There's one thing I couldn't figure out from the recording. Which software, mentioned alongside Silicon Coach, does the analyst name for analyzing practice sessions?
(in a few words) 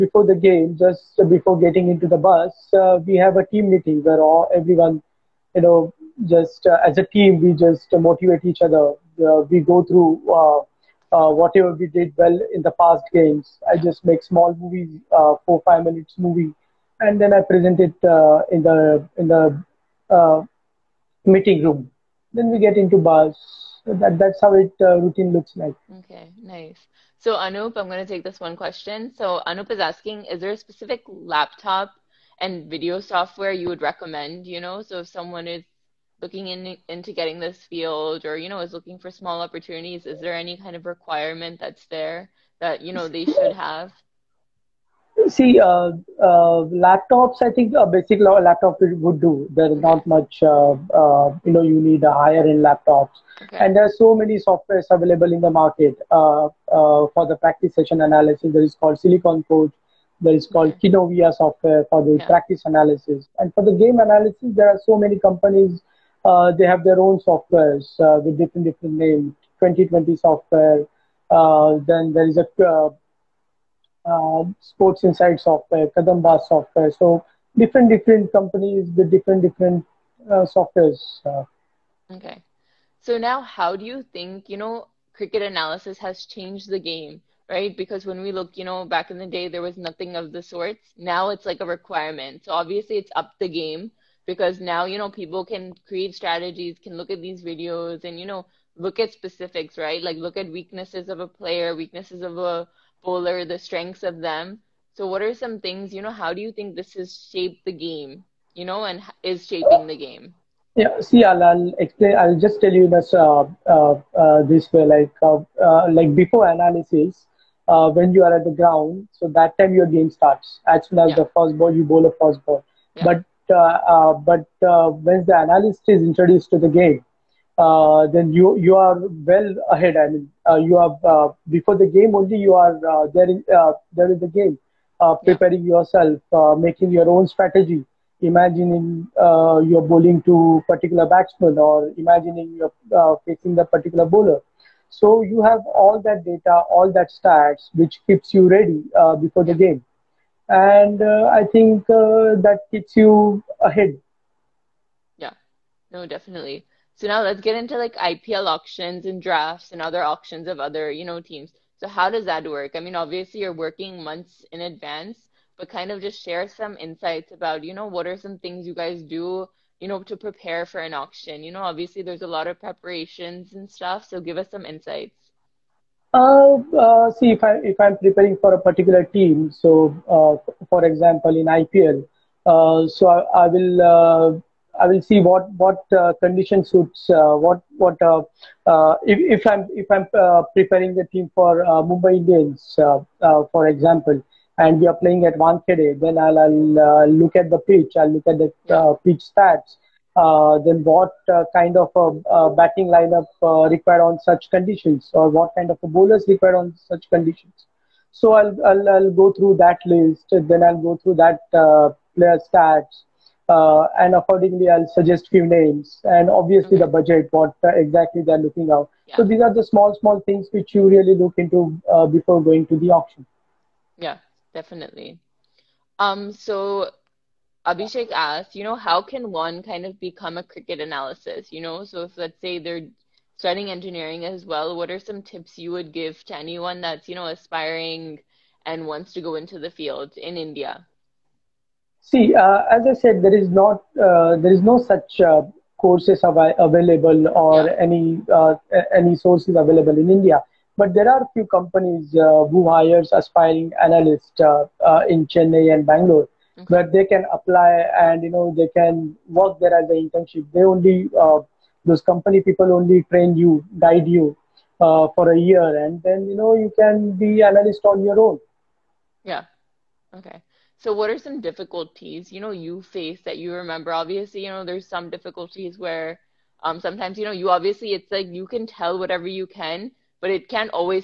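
Kinovea.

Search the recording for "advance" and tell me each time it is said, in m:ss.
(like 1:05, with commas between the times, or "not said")
2:44.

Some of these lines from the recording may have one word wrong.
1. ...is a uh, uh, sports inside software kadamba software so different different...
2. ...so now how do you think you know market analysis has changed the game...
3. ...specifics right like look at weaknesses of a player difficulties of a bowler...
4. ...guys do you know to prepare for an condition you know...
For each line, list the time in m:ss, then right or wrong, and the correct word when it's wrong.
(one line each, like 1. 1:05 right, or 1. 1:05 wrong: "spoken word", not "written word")
1. 1:12 right
2. 1:23 wrong: "cricket", not "market"
3. 1:39 wrong: "weaknesses", not "difficulties"
4. 2:48 wrong: "auction", not "condition".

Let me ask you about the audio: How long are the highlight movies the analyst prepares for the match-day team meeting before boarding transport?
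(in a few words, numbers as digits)
4-5 minutes.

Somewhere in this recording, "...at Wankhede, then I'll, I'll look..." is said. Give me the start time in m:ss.
3:15.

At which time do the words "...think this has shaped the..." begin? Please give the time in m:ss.
1:46.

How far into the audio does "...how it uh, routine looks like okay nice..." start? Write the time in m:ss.
0:24.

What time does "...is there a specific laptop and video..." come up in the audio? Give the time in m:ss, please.
0:30.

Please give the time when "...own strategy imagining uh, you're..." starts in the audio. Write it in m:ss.
2:17.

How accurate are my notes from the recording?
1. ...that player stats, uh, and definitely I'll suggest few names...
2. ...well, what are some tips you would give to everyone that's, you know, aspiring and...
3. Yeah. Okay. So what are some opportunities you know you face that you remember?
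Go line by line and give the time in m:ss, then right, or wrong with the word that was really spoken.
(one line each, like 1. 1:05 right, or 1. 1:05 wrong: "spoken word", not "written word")
1. 3:31 wrong: "accordingly", not "definitely"
2. 3:54 wrong: "anyone", not "everyone"
3. 4:29 wrong: "difficulties", not "opportunities".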